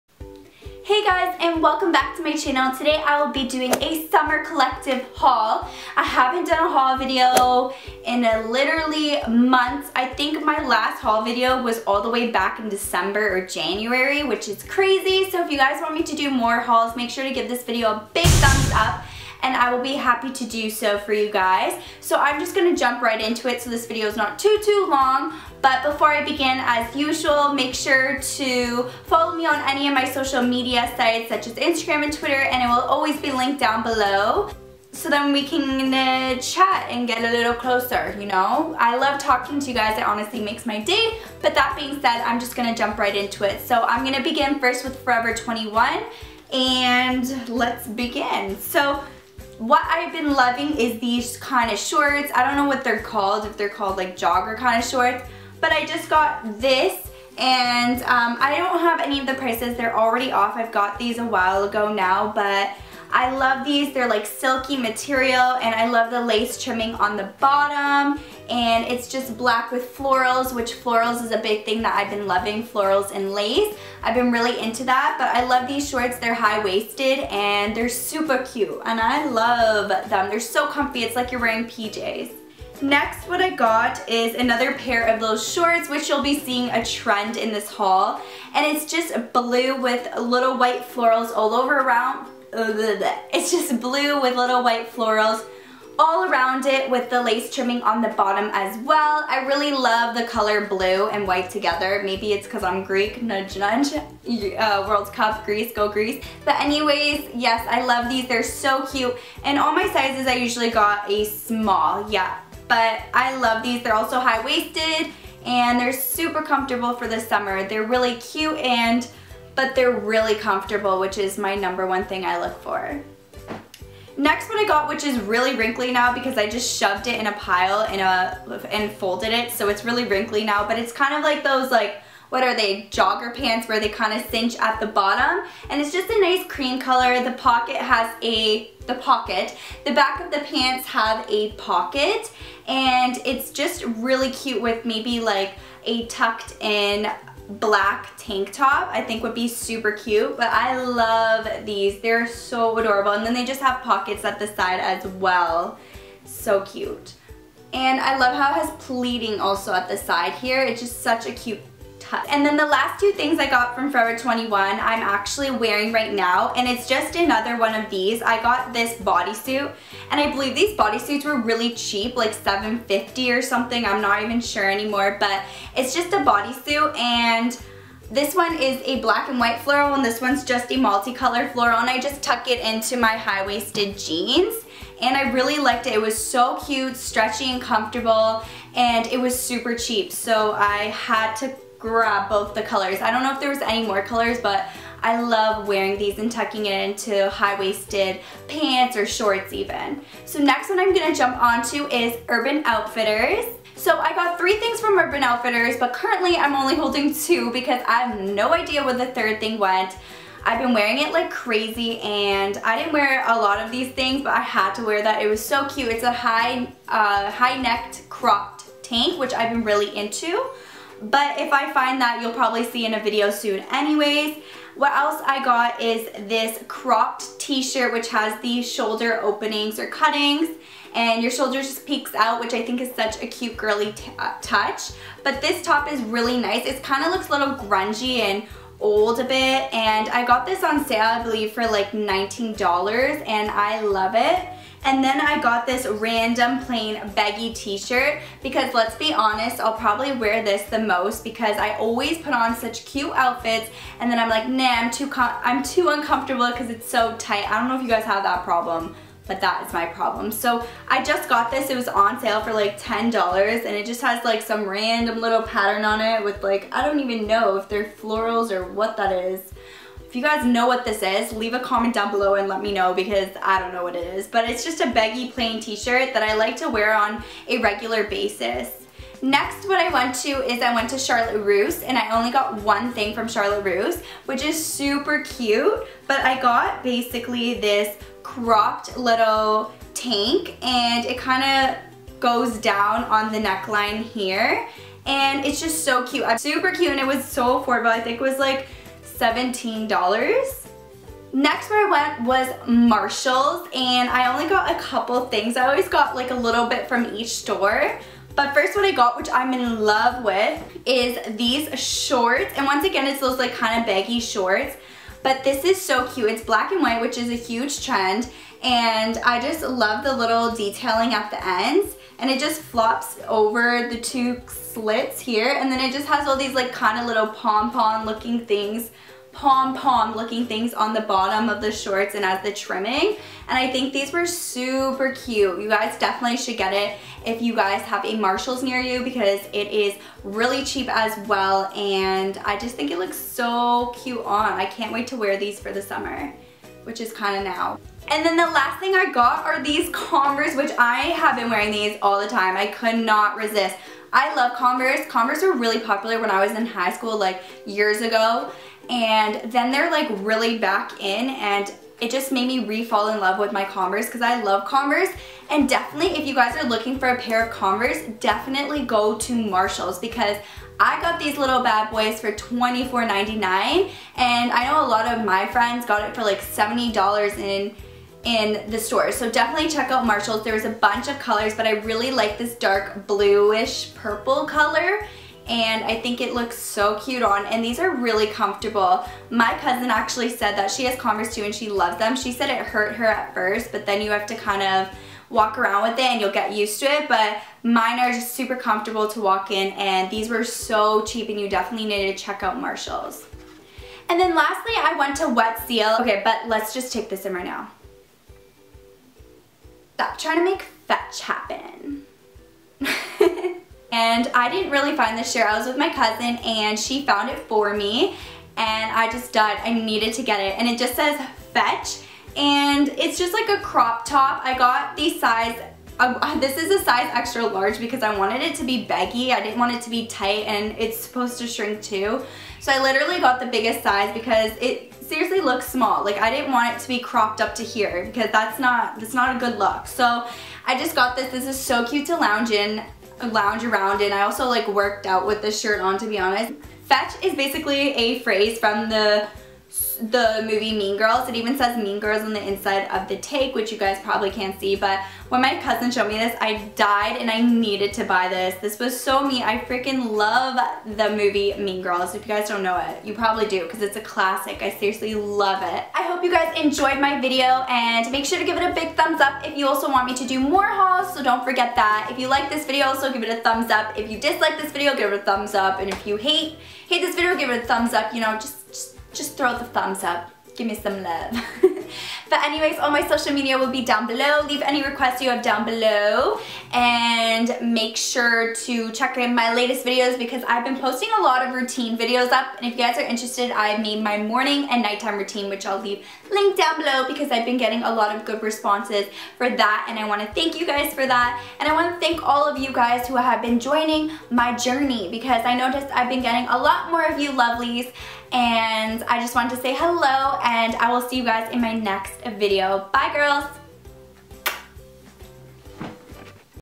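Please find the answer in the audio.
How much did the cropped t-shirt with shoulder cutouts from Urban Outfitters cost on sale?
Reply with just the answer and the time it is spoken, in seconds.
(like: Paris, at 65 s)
$19, at 241 s.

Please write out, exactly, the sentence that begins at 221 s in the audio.
But if I find that, you'll probably see in a video soon anyways.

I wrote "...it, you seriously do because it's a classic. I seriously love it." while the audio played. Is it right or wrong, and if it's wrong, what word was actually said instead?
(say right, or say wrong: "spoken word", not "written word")
wrong: "probably", not "seriously".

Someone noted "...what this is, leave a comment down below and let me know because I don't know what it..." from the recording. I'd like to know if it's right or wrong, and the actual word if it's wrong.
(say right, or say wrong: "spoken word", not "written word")
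right.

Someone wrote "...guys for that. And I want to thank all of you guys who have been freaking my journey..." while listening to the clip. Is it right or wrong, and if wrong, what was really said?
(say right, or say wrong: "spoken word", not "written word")
wrong: "joining", not "freaking".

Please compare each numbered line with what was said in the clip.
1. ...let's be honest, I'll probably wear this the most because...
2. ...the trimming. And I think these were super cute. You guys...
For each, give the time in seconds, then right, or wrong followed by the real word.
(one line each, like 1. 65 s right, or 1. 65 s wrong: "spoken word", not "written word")
1. 248 s right
2. 332 s right.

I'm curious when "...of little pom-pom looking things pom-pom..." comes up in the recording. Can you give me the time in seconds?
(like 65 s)
326 s.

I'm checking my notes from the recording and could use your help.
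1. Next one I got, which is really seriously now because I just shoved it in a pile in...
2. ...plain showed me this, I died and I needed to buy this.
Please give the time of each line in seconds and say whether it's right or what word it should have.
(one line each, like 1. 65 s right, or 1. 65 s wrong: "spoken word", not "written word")
1. 124 s wrong: "wrinkly", not "seriously"
2. 455 s wrong: "cousin", not "plain".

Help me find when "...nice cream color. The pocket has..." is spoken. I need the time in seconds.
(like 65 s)
136 s.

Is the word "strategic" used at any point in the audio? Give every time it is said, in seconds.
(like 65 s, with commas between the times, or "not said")
not said.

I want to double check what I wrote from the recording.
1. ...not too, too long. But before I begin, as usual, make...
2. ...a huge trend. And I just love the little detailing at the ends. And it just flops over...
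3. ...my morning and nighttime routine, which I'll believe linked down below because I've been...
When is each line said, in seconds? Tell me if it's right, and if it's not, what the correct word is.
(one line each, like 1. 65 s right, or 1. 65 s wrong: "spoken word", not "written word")
1. 24 s right
2. 317 s right
3. 494 s wrong: "leave", not "believe".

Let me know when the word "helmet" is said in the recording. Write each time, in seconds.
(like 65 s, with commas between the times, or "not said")
not said.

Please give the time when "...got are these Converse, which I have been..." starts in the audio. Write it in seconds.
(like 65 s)
349 s.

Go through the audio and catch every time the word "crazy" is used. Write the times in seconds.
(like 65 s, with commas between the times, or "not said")
14 s, 211 s.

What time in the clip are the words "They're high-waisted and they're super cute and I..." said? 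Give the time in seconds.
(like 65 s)
76 s.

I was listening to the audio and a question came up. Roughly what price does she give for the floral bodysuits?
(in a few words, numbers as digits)
7.50.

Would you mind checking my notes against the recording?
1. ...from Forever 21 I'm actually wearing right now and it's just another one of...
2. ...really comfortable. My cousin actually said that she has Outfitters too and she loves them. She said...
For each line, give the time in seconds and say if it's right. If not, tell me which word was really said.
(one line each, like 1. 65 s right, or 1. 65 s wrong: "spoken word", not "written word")
1. 163 s right
2. 387 s wrong: "Converse", not "Outfitters".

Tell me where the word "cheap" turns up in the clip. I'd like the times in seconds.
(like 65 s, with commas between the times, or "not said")
171 s, 189 s, 340 s, 401 s.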